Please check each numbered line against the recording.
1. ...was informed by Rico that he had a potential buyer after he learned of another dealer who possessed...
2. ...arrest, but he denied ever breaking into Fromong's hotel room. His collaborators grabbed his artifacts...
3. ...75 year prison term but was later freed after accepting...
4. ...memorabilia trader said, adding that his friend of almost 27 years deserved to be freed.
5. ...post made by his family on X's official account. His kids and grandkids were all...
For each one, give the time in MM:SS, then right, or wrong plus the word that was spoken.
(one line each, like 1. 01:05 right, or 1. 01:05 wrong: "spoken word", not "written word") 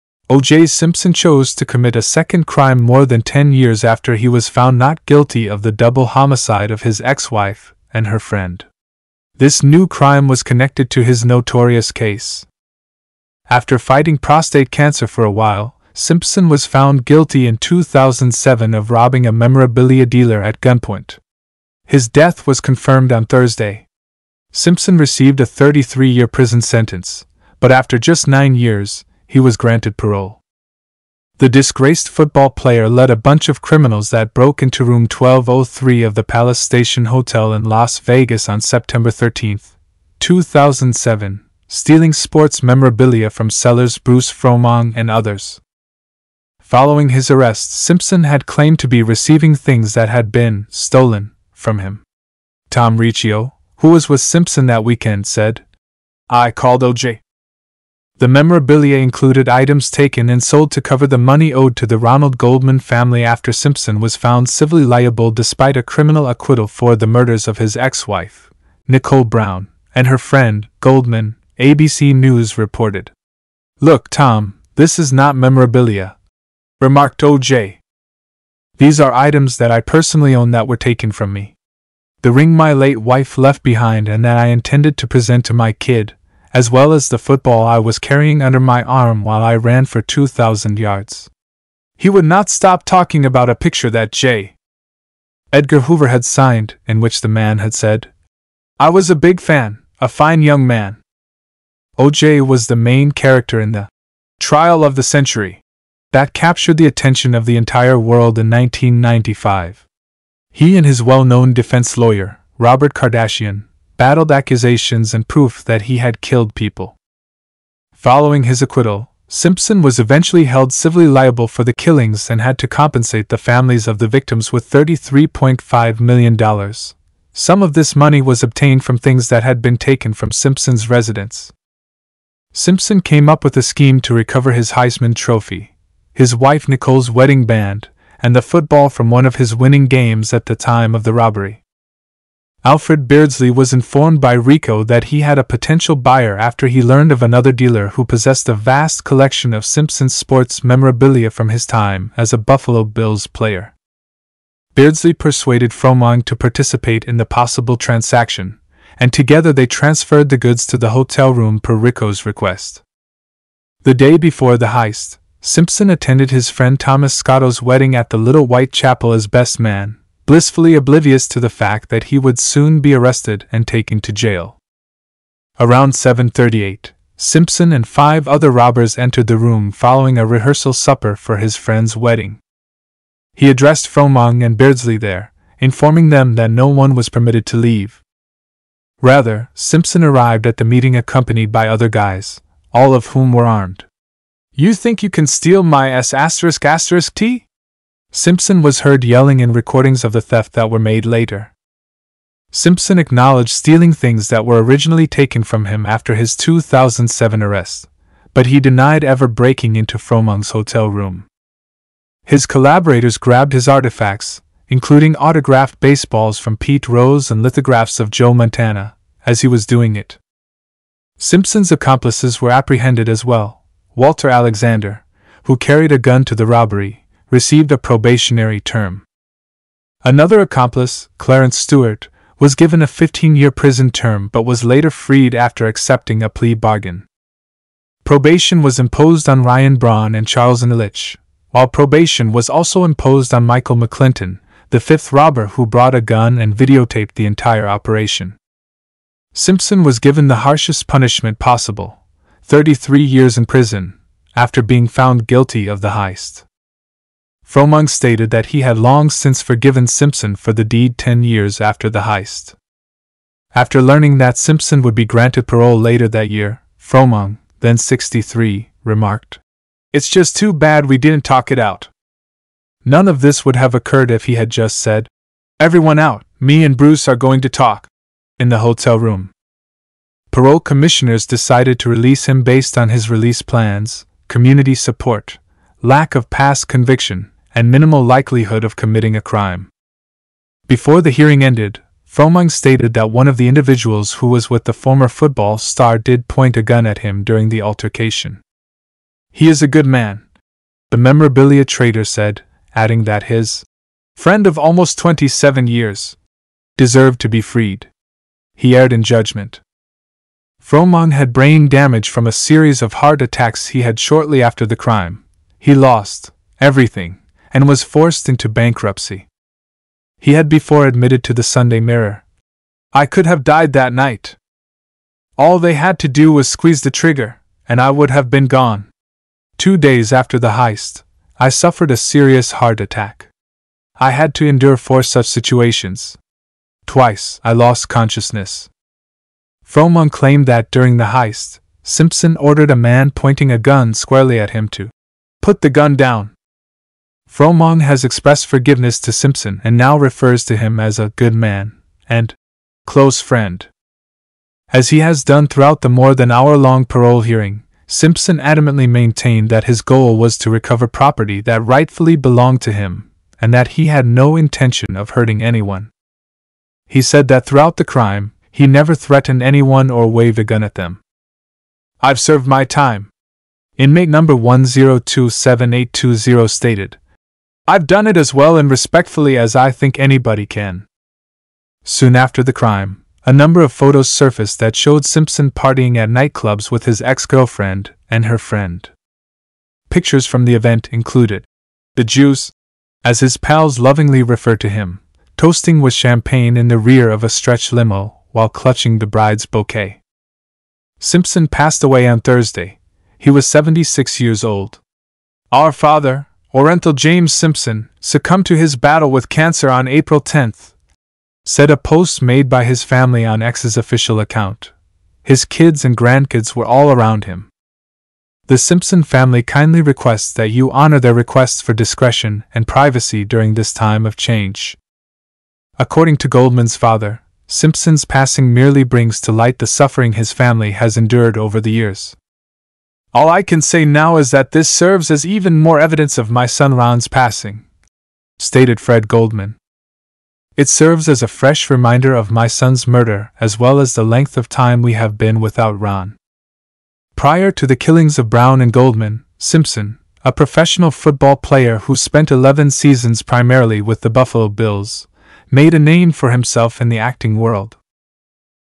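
1. 02:23 right
2. 03:27 right
3. 03:52 wrong: "15", not "75"
4. 05:00 right
5. 06:51 right.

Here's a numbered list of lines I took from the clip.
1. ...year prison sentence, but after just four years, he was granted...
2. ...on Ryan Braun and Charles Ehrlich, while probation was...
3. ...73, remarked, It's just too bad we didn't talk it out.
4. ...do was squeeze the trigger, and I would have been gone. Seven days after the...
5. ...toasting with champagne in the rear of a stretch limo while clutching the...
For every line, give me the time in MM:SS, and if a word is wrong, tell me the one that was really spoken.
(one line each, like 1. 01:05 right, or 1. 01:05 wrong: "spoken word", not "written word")
1. 00:26 wrong: "nine", not "four"
2. 03:59 right
3. 04:27 wrong: "63", not "73"
4. 05:26 wrong: "Two", not "Seven"
5. 06:35 right.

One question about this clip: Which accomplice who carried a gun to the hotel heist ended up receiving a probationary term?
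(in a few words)
Walter Alexander.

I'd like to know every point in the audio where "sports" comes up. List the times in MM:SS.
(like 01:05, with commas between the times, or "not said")
00:42, 02:30.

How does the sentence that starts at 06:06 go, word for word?
He said that throughout the crime, he never threatened anyone or waved a gun at them.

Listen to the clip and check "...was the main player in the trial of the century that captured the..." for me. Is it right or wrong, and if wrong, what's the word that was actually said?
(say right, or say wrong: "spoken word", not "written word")
wrong: "character", not "player".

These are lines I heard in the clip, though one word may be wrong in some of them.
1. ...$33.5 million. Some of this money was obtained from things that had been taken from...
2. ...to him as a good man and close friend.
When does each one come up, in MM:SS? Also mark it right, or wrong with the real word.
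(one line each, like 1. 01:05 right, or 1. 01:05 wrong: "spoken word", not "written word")
1. 02:04 right
2. 05:50 right.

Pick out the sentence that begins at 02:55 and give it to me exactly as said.
Around 7:38, Simpson and five other robbers entered the room following a rehearsal supper for his friend's wedding.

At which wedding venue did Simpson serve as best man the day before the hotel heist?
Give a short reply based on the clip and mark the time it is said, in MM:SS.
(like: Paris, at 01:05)
Little White Chapel, at 02:48.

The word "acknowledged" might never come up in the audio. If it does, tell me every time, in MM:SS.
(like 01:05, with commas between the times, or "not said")
03:22.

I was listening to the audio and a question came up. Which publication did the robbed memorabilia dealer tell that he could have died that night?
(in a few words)
Sunday Mirror.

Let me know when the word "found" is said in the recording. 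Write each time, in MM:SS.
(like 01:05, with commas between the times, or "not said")
00:04, 00:16, 01:04, 04:14.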